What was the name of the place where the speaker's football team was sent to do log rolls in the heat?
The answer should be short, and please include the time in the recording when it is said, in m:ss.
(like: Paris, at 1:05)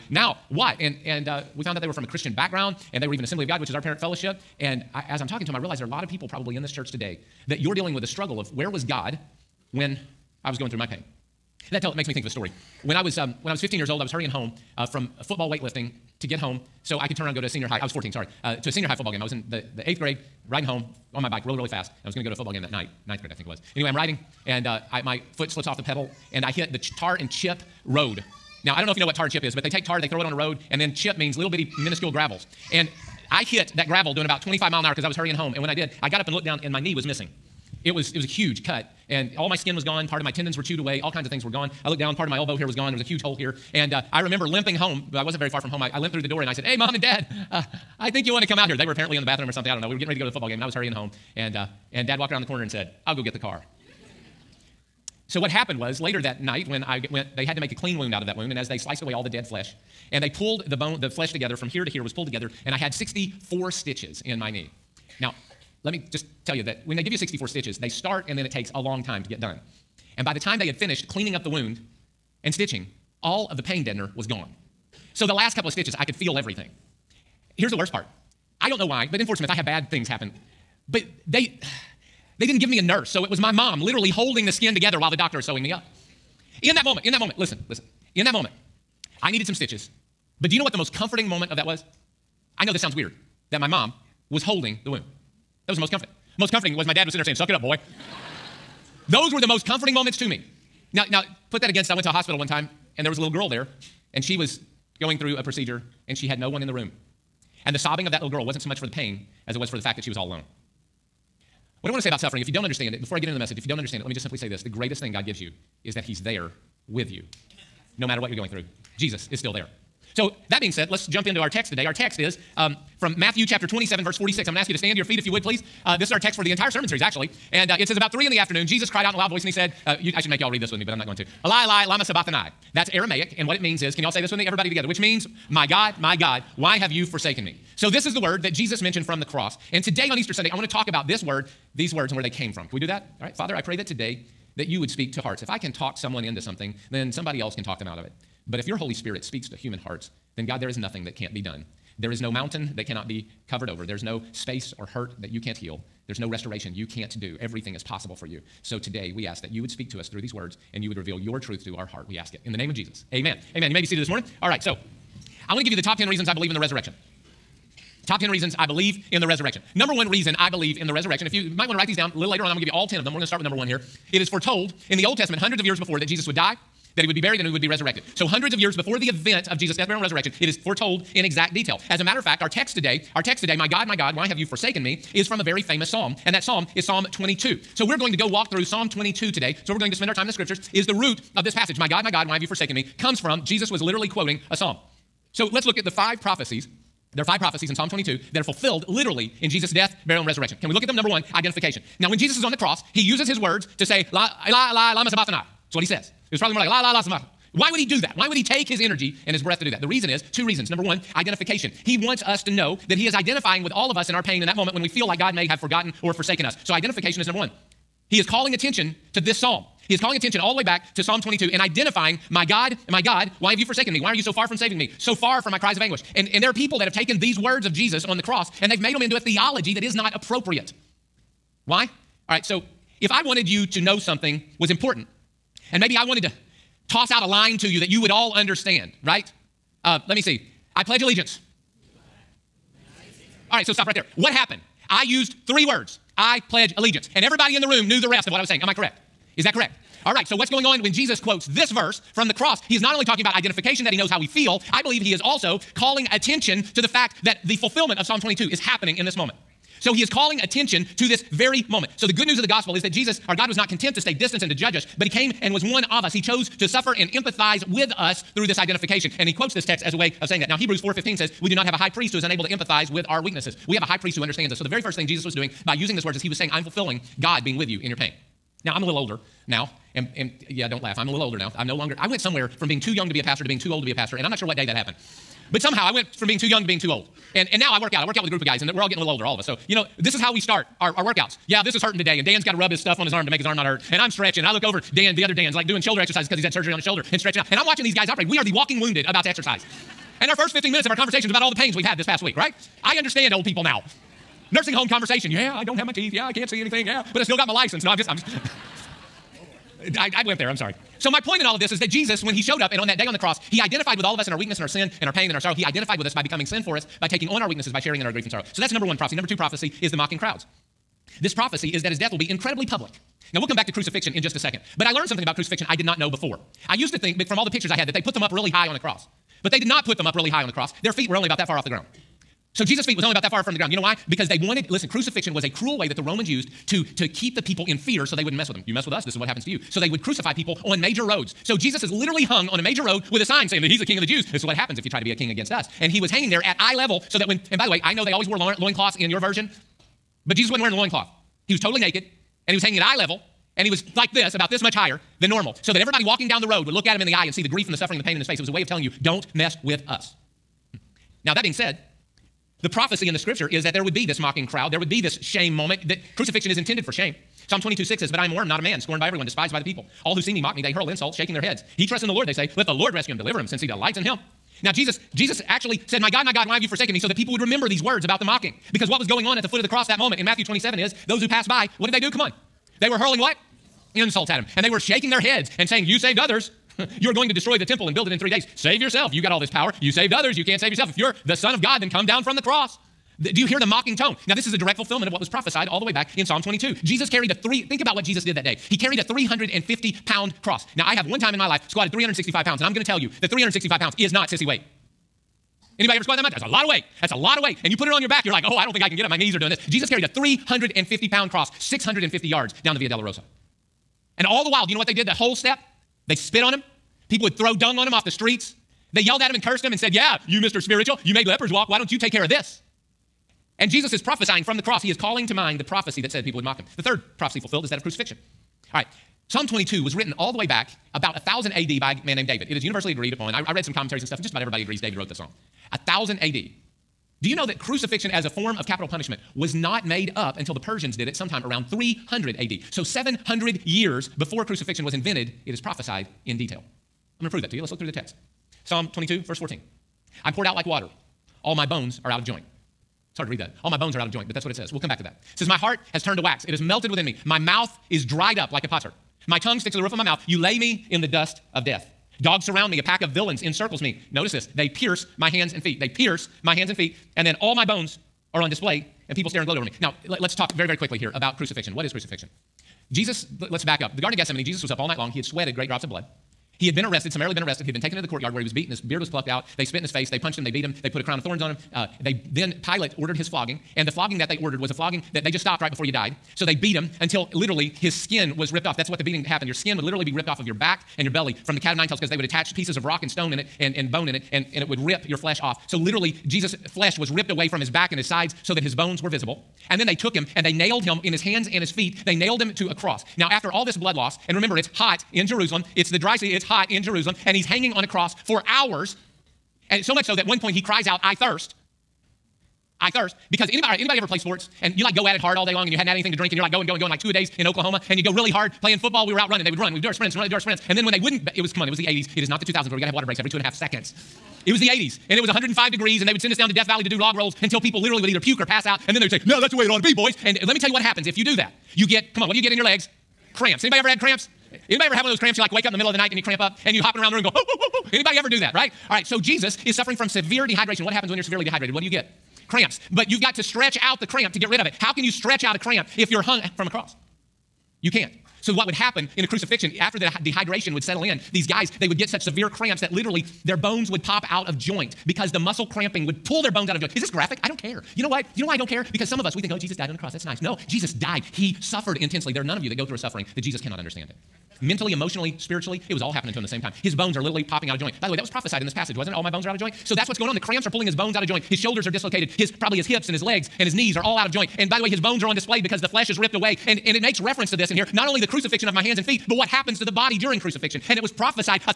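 Death Valley, at 8:46.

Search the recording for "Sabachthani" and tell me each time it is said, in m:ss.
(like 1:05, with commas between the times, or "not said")
2:12, 3:25.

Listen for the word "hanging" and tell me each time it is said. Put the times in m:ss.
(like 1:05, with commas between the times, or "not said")
5:46, 5:52, 8:27.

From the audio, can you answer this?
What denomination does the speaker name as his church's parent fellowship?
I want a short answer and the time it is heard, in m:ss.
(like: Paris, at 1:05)
Assembly of God, at 0:03.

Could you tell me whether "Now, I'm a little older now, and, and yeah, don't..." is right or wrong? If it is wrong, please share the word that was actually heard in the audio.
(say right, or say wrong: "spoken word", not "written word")
right.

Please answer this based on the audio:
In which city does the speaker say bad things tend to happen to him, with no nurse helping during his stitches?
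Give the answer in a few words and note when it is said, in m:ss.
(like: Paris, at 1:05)
Fort Smith, at 1:19.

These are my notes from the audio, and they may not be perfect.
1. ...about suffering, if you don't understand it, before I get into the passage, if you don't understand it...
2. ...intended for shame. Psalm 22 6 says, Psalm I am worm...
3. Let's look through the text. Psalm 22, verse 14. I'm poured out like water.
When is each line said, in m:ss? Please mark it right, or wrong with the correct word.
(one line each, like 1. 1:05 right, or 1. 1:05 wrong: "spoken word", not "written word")
1. 1:52 wrong: "message", not "passage"
2. 6:06 wrong: "But", not "Psalm"
3. 7:27 right.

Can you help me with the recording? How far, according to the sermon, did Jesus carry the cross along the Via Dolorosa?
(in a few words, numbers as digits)
650 yards.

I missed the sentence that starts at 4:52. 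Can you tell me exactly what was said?
And Dan's got to rub his stuff on his arm to make his arm not hurt.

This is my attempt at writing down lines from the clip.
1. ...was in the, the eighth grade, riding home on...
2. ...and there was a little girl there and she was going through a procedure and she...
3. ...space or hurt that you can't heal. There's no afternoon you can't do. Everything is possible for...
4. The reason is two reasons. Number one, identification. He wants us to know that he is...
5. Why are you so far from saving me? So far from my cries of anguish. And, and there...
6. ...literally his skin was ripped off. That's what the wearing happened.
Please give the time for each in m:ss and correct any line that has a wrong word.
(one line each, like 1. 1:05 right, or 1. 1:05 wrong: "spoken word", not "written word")
1. 0:19 right
2. 1:42 right
3. 2:34 wrong: "restoration", not "afternoon"
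4. 3:29 right
5. 3:43 right
6. 8:07 wrong: "beating", not "wearing".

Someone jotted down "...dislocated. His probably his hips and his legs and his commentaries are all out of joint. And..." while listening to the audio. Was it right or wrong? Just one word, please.
wrong.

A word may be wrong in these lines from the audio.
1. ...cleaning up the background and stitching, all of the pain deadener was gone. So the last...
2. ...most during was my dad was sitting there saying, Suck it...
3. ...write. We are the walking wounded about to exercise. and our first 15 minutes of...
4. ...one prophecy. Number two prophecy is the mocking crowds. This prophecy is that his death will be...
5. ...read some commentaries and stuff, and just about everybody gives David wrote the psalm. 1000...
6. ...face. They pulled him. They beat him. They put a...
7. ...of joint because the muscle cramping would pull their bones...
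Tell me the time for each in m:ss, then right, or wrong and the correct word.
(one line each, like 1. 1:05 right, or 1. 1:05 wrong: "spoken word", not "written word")
1. 1:11 wrong: "wound", not "background"
2. 1:36 wrong: "comforting", not "during"
3. 4:58 wrong: "operate", not "write"
4. 5:18 right
5. 7:13 wrong: "agrees", not "gives"
6. 7:59 wrong: "punched", not "pulled"
7. 9:14 right.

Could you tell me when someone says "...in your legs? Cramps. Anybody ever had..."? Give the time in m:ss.
8:52.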